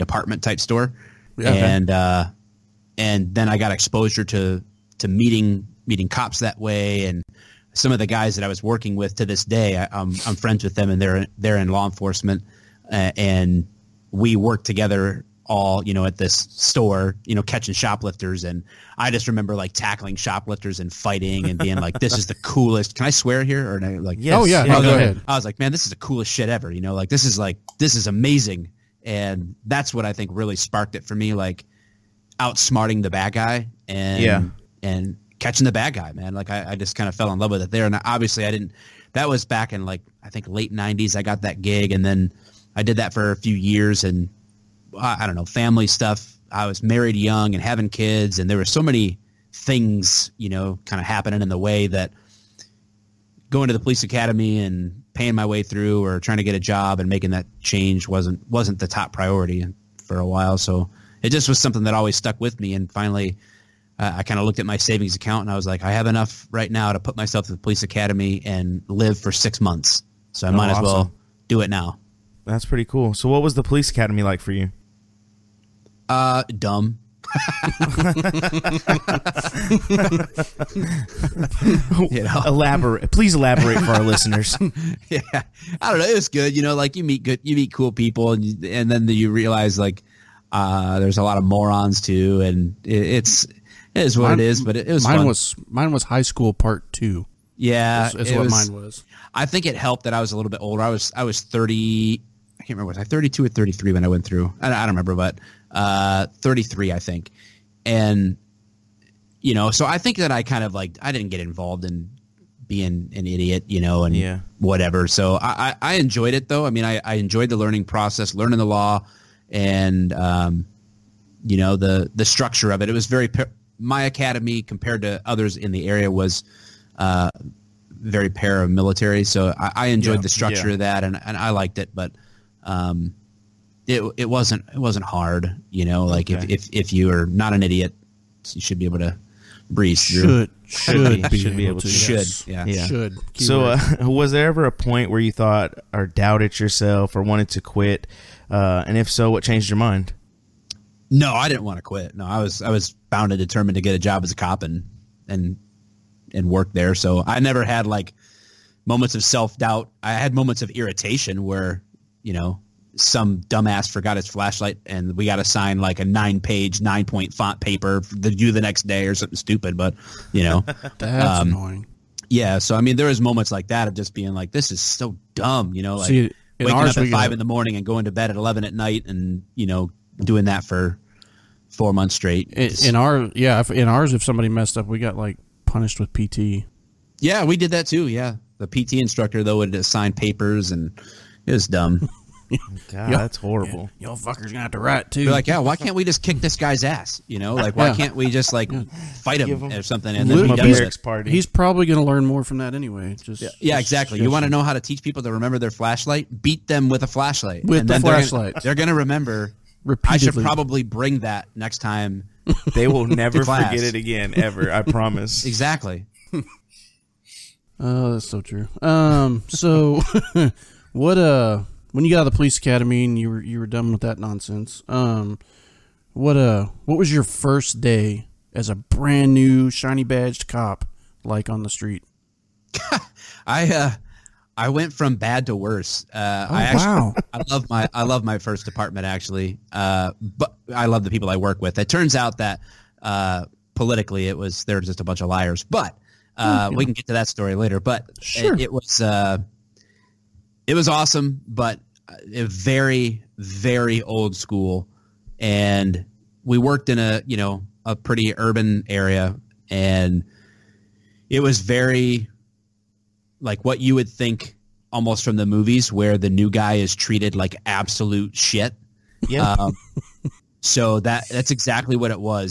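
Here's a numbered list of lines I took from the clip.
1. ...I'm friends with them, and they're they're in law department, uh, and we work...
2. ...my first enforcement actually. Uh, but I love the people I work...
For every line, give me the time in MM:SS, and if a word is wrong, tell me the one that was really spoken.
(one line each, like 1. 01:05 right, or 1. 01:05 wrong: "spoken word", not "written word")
1. 00:10 wrong: "enforcement", not "department"
2. 03:58 wrong: "department", not "enforcement".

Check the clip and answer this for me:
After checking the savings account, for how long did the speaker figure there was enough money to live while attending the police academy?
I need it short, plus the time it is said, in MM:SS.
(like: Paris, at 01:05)
6 months, at 01:09.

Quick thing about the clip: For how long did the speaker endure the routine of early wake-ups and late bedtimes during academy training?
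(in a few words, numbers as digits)
4 months.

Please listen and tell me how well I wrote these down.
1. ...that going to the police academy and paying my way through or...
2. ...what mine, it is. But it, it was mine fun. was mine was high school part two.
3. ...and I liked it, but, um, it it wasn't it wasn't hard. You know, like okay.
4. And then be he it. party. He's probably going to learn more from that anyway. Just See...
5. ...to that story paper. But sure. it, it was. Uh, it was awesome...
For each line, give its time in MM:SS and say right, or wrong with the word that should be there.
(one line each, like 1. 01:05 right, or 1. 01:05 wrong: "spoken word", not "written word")
1. 00:51 right
2. 01:34 right
3. 02:11 right
4. 03:20 wrong: "Yeah", not "See"
5. 04:07 wrong: "later", not "paper".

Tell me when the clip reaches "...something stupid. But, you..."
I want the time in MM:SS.
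02:49.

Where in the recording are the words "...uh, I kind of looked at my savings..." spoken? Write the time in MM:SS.
01:03.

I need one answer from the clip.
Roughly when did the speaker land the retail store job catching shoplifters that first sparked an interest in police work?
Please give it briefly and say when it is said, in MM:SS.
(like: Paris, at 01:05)
late 1990s, at 00:40.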